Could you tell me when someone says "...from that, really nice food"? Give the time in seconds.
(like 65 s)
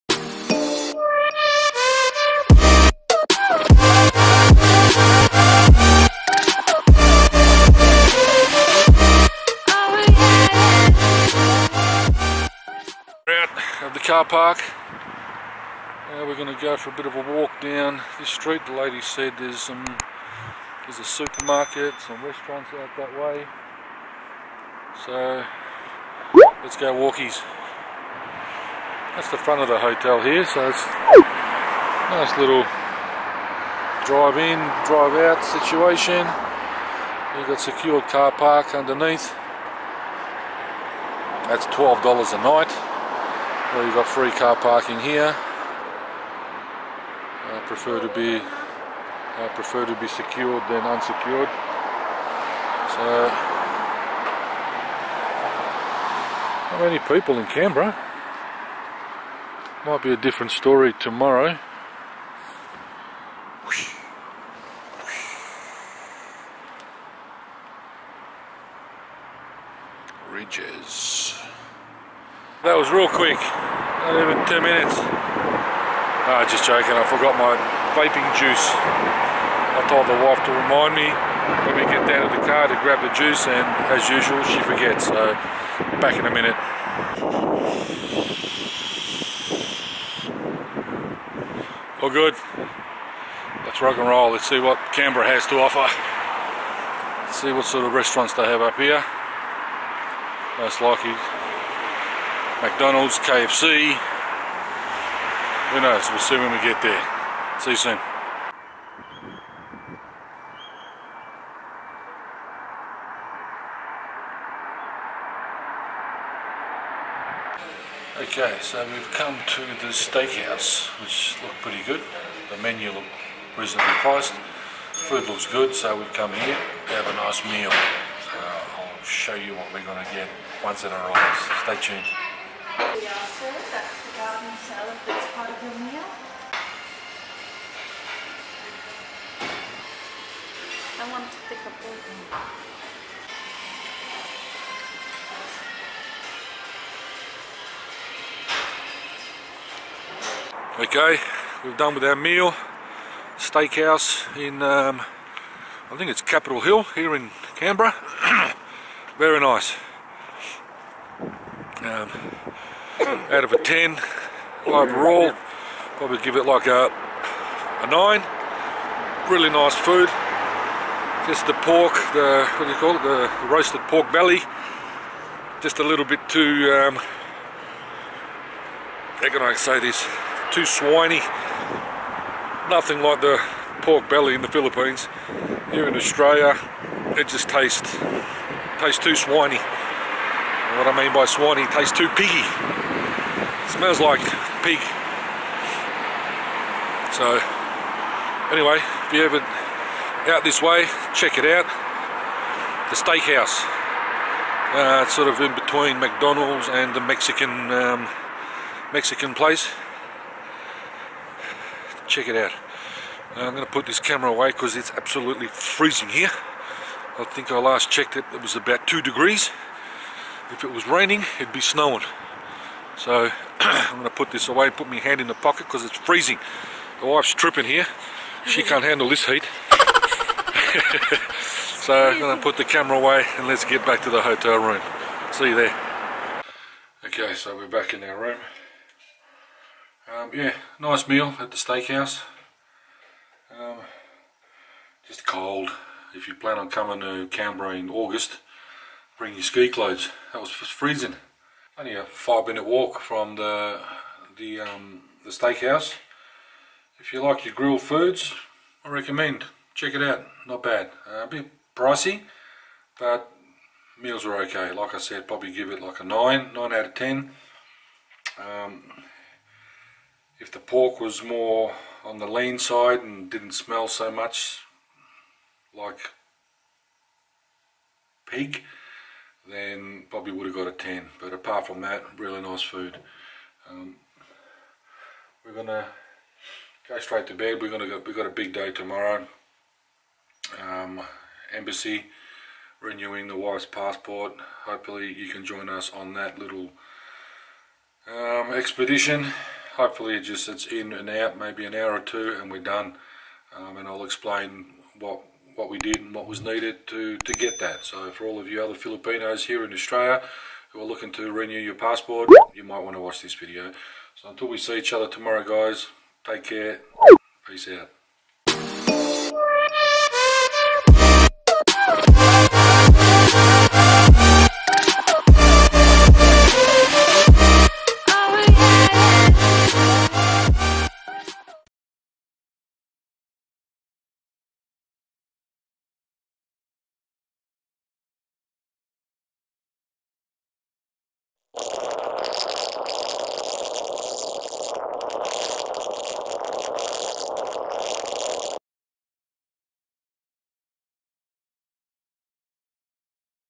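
281 s.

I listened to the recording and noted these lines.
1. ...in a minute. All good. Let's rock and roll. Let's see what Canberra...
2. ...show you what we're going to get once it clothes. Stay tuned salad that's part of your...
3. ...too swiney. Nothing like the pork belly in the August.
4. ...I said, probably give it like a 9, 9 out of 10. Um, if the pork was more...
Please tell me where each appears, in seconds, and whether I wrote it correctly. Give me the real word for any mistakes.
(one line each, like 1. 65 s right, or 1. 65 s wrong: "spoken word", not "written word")
1. 86 s right
2. 129 s wrong: "arrives", not "clothes"
3. 180 s wrong: "Philippines", not "August"
4. 264 s right.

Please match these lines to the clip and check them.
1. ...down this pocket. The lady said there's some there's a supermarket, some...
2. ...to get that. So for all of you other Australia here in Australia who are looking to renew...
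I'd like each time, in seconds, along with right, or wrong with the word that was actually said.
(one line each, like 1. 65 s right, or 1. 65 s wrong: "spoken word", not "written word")
1. 17 s wrong: "street", not "pocket"
2. 307 s wrong: "Filipinos", not "Australia".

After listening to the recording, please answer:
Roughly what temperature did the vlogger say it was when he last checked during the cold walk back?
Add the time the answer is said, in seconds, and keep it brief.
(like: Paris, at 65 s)
2 degrees, at 218 s.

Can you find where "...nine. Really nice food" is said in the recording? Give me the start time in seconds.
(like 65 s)
167 s.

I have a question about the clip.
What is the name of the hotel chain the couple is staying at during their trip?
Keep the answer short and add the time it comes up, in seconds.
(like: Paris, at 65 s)
Rydges, at 70 s.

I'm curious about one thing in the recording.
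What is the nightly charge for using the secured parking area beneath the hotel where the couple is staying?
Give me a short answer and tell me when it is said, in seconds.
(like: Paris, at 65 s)
$12, at 41 s.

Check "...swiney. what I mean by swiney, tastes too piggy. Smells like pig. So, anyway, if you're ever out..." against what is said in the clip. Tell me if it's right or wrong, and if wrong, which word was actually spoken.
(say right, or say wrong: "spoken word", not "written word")
right.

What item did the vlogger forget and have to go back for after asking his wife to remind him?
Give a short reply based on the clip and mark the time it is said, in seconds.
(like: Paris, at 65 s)
vaping juice, at 77 s.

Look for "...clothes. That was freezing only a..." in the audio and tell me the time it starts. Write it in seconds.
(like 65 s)
249 s.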